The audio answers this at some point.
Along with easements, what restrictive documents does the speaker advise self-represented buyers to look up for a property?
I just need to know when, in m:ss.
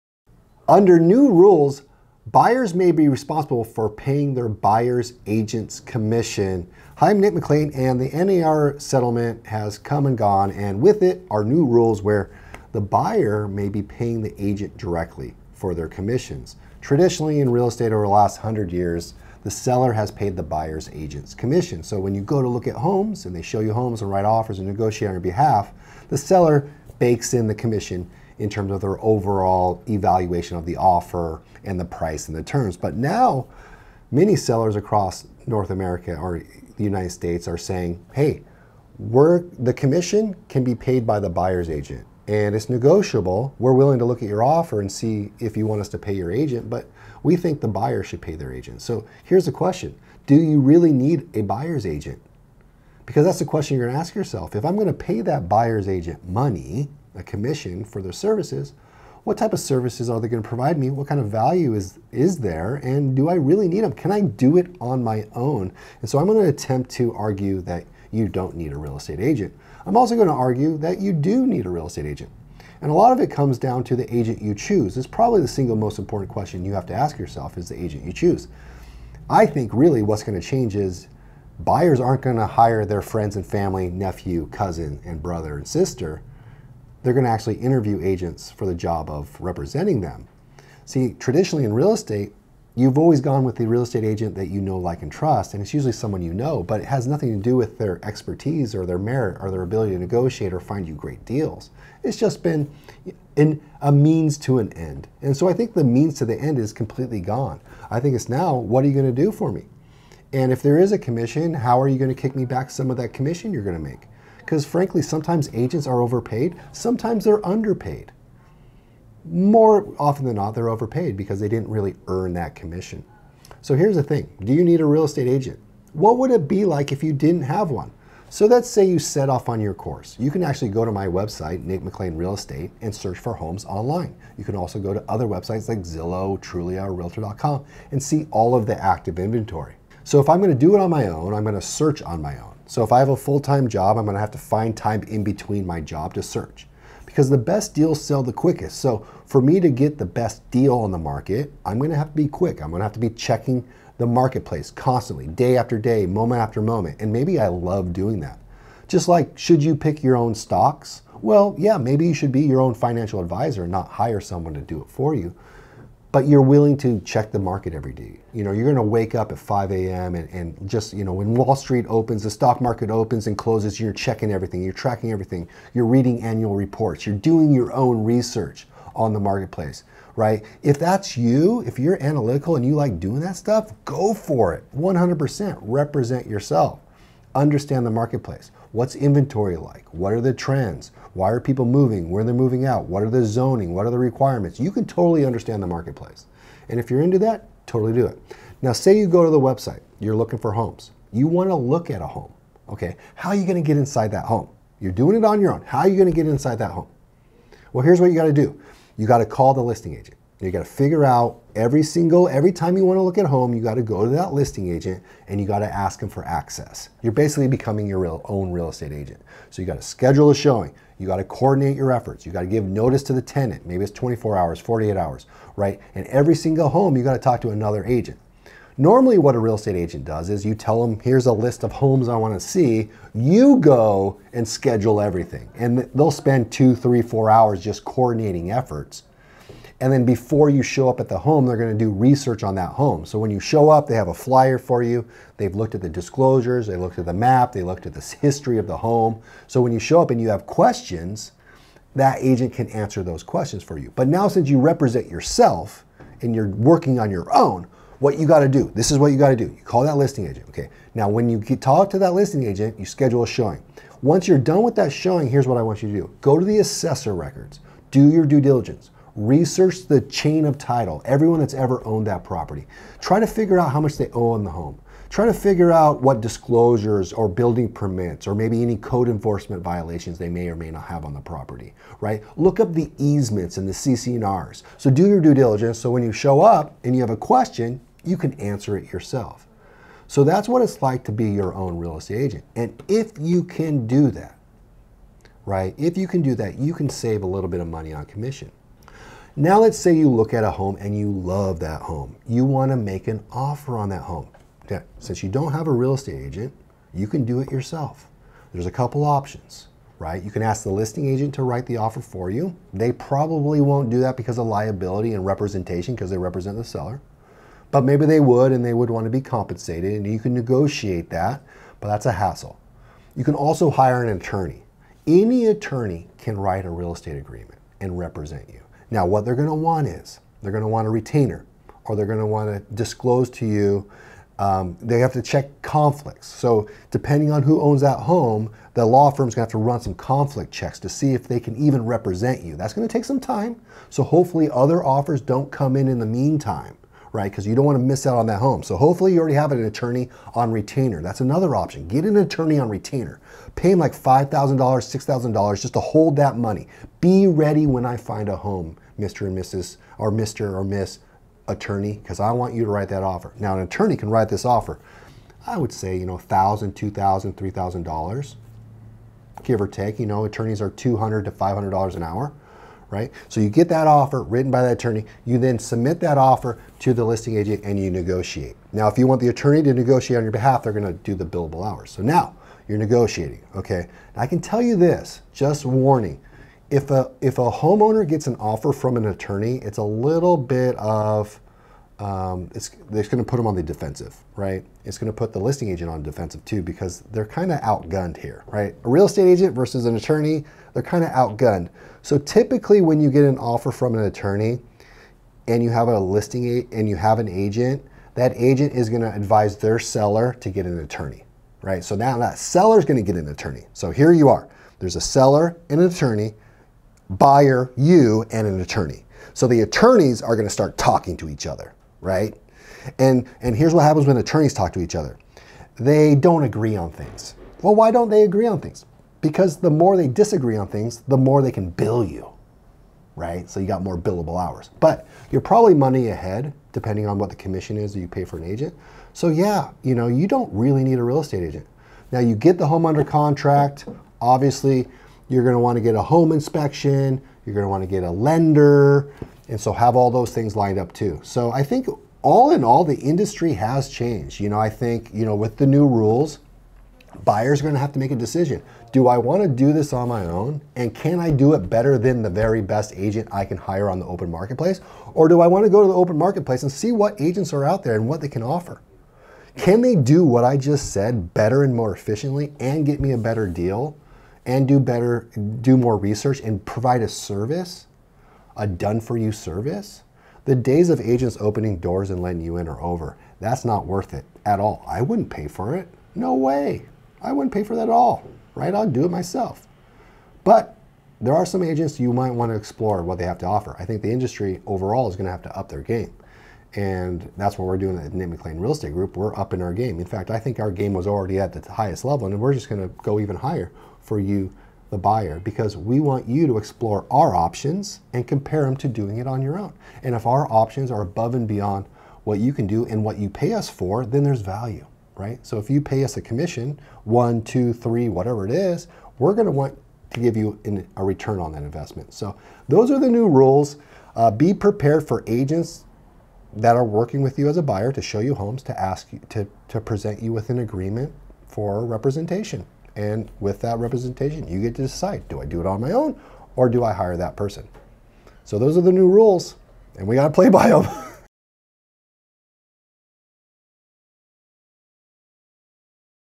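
4:43.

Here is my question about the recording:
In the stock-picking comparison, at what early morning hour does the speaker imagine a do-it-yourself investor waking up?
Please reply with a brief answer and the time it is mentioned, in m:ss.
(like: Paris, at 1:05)
5 a.m., at 2:49.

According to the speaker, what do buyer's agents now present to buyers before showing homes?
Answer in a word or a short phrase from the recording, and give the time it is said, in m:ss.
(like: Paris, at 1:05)
agreement for representation, at 8:50.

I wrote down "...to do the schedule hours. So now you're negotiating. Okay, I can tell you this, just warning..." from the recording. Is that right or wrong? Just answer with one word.
wrong.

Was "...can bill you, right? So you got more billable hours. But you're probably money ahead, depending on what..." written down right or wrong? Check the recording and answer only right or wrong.
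right.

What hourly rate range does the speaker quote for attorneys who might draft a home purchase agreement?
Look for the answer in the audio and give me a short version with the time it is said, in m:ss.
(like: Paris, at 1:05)
$200 to $500, at 6:10.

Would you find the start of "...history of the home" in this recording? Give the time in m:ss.
4:08.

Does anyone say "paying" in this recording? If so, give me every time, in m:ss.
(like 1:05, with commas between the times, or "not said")
0:03, 0:13.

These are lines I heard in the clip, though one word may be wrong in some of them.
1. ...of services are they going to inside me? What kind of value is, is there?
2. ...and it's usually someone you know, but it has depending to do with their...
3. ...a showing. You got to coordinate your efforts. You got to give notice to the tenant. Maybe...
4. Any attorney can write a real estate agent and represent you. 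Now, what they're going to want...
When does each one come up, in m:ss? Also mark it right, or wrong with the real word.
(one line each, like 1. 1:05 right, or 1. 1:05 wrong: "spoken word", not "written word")
1. 0:59 wrong: "provide", not "inside"
2. 1:35 wrong: "nothing", not "depending"
3. 3:40 right
4. 5:25 wrong: "agreement", not "agent".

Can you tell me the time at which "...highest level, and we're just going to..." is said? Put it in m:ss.
8:21.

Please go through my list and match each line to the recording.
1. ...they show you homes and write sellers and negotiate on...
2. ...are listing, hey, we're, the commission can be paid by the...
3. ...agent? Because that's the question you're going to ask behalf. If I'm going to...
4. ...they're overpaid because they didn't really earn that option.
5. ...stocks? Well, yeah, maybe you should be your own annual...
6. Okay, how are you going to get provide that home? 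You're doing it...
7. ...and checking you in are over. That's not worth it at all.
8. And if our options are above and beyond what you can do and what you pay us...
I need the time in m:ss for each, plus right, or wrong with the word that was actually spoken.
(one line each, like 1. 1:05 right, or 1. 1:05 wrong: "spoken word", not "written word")
1. 0:23 wrong: "offers", not "sellers"
2. 0:37 wrong: "saying", not "listing"
3. 0:51 wrong: "yourself", not "behalf"
4. 2:00 wrong: "commission", not "option"
5. 2:40 wrong: "financial", not "annual"
6. 3:22 wrong: "inside", not "provide"
7. 8:02 wrong: "letting", not "checking"
8. 8:30 right.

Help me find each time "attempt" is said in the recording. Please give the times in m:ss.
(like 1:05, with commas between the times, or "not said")
1:06.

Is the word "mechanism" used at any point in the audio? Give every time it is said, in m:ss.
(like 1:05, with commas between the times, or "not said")
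not said.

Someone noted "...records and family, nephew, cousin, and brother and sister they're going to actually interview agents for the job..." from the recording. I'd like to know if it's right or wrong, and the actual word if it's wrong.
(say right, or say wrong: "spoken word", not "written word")
wrong: "friends", not "records".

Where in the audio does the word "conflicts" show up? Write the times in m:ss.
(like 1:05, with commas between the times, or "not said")
5:35, 5:39.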